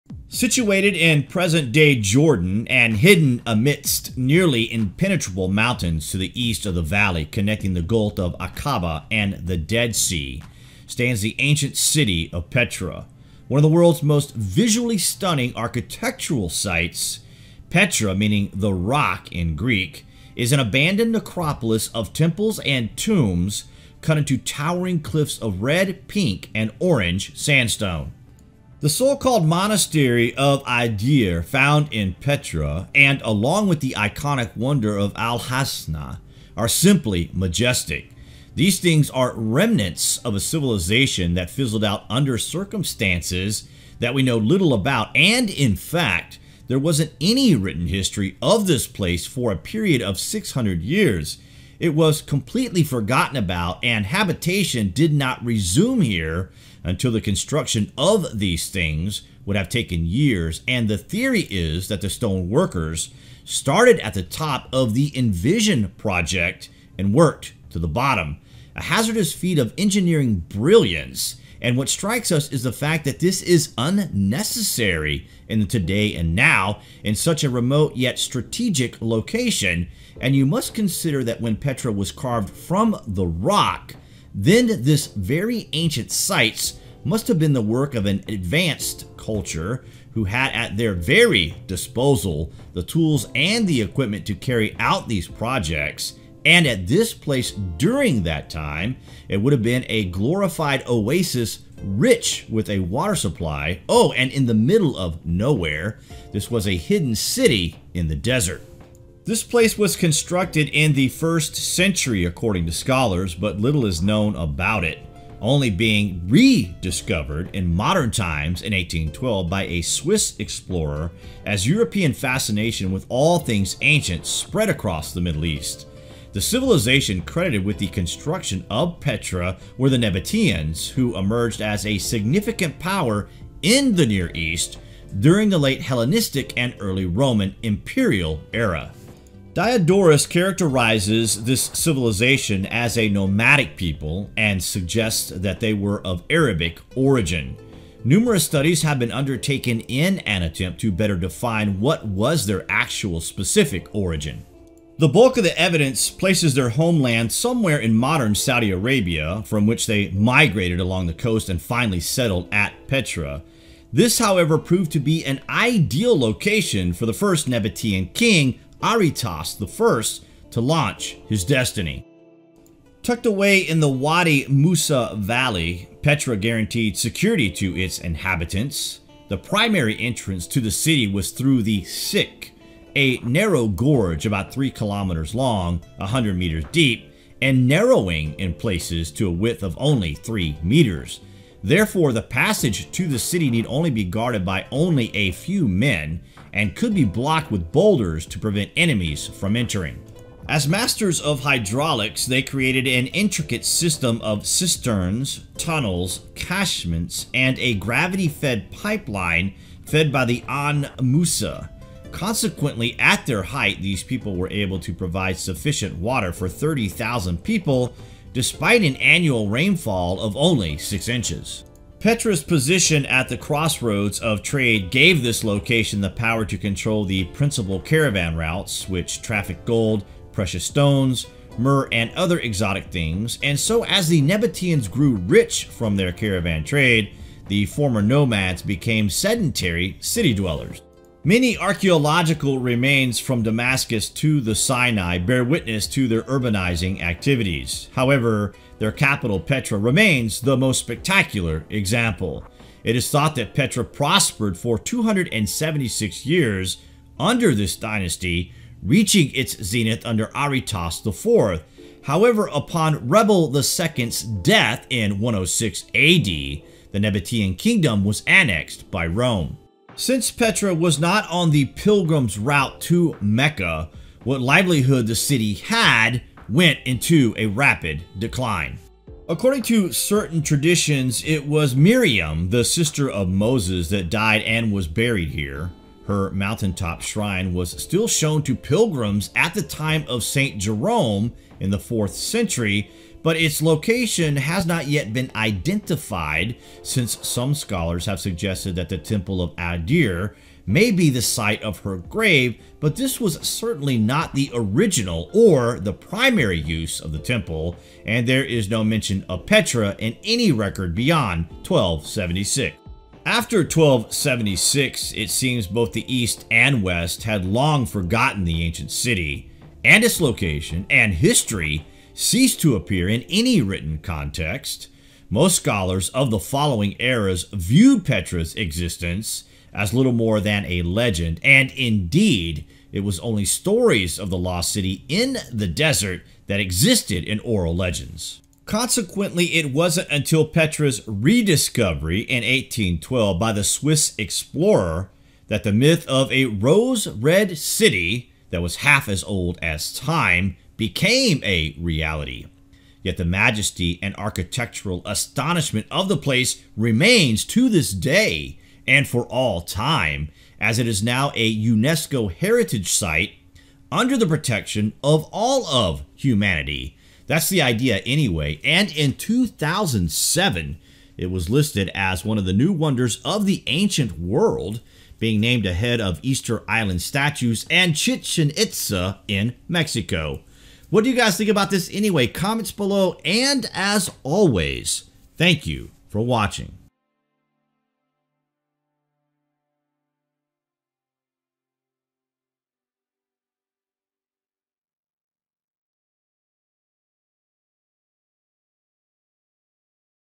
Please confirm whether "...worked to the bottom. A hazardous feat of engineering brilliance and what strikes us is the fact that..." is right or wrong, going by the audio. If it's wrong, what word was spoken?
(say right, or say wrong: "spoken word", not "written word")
right.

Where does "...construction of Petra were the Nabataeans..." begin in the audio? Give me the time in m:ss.
2:07.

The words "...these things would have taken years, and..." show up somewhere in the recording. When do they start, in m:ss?
0:58.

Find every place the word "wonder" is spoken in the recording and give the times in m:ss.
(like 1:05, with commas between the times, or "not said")
0:34, 6:12.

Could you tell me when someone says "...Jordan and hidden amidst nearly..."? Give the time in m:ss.
0:01.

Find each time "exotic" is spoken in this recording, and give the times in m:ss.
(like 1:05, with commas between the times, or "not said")
3:52.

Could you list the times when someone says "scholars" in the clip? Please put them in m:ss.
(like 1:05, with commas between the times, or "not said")
1:52, 4:57, 5:25.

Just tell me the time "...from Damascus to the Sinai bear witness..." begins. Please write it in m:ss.
4:03.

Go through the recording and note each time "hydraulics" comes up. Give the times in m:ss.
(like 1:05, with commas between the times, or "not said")
3:21.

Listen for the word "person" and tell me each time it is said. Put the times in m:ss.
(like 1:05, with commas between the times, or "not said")
not said.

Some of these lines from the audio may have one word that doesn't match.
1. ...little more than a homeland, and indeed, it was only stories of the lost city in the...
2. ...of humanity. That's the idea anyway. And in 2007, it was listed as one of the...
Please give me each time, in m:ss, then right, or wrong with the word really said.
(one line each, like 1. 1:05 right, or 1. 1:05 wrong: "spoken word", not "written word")
1. 5:29 wrong: "legend", not "homeland"
2. 6:05 right.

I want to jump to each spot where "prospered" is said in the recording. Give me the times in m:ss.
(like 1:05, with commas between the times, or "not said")
4:13.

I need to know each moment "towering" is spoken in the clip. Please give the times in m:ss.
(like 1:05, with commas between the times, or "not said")
0:24.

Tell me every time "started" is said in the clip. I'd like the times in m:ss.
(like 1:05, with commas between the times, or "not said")
1:03.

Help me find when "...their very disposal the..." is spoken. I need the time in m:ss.
1:30.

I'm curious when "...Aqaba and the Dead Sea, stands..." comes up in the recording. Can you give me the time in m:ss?
0:08.